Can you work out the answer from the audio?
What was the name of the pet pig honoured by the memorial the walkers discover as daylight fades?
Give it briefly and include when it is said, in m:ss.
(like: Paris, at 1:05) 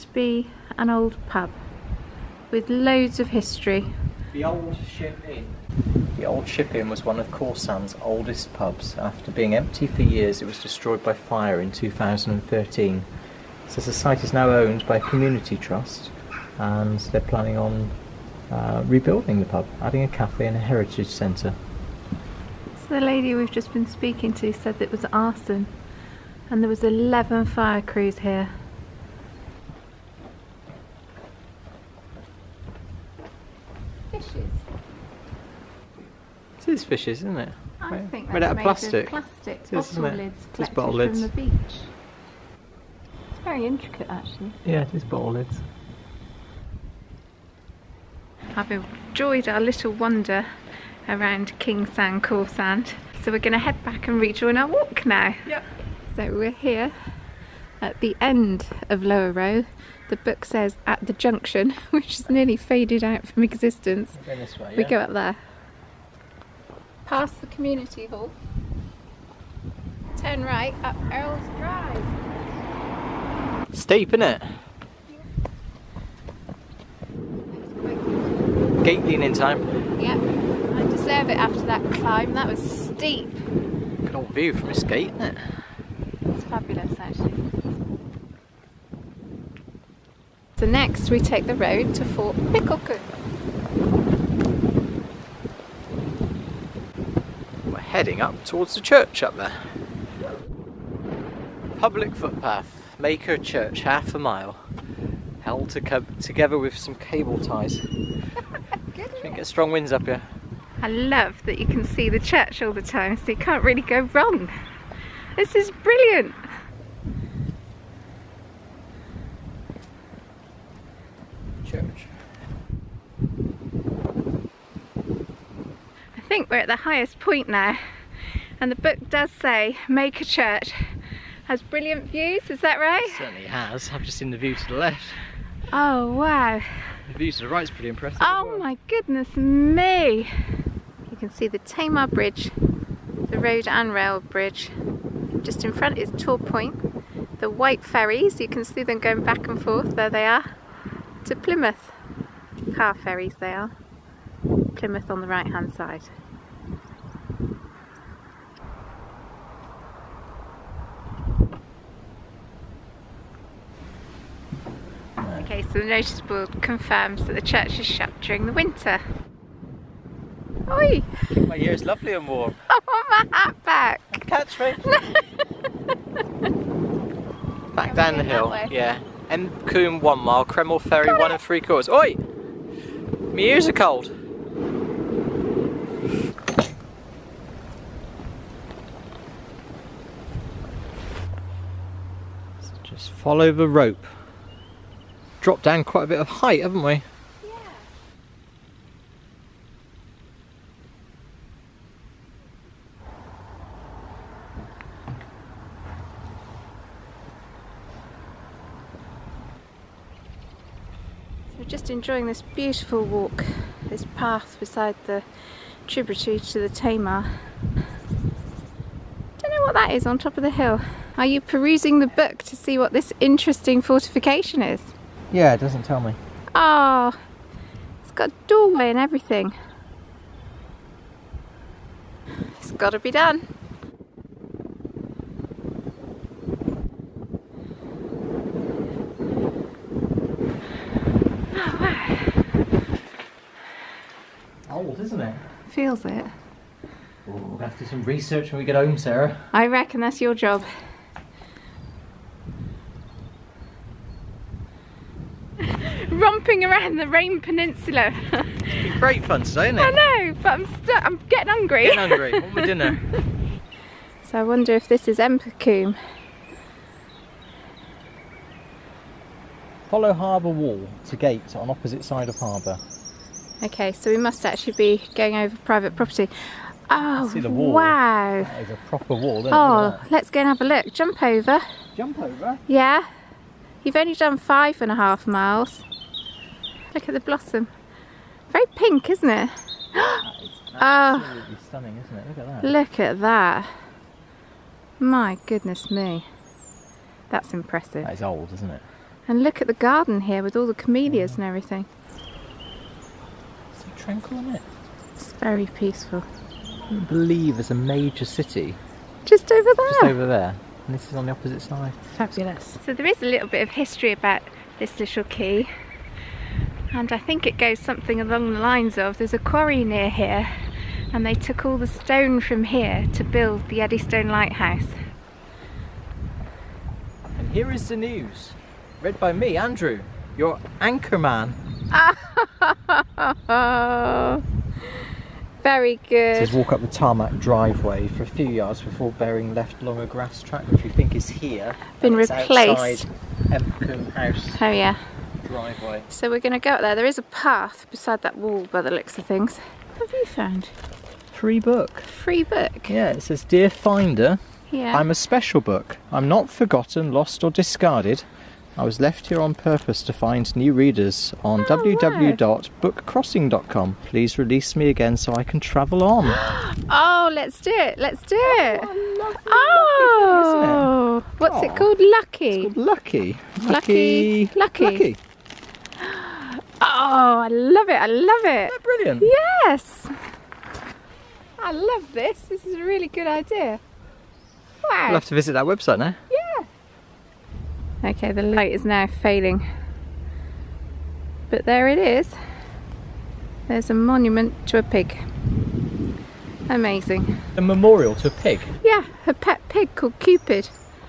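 Cupid, at 6:40.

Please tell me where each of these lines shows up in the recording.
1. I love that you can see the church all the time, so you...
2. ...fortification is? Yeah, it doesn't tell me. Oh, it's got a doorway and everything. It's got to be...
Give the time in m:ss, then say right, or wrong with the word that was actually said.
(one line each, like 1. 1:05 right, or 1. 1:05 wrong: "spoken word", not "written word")
1. 1:50 right
2. 3:43 right.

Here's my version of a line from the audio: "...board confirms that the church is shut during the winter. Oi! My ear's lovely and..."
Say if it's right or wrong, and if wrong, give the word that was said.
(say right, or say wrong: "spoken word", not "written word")
right.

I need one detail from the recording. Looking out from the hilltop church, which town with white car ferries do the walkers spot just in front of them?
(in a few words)
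Torpoint.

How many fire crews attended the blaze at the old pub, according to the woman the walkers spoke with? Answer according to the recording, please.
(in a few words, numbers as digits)
11.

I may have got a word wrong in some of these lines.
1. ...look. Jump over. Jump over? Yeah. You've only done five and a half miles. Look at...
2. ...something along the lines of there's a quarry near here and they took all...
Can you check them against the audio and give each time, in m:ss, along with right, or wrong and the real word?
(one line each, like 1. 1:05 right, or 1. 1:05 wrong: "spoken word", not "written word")
1. 4:40 right
2. 5:17 right.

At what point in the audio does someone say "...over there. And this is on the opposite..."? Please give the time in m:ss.
5:10.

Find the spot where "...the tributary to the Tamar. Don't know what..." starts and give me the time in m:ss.
3:35.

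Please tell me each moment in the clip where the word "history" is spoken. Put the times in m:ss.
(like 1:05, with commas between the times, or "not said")
0:03, 5:13.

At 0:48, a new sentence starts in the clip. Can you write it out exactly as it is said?
I've enjoyed our little wonder around Kingsand, Cool Sand.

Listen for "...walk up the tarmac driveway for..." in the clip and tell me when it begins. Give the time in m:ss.
5:36.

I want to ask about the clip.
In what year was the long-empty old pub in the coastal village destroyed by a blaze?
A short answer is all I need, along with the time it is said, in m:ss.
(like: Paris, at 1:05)
2013, at 0:11.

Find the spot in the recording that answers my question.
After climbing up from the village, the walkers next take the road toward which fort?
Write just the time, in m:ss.
1:32.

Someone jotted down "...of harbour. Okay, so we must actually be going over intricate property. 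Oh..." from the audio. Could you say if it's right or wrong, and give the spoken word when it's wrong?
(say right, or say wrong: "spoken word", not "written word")
wrong: "private", not "intricate".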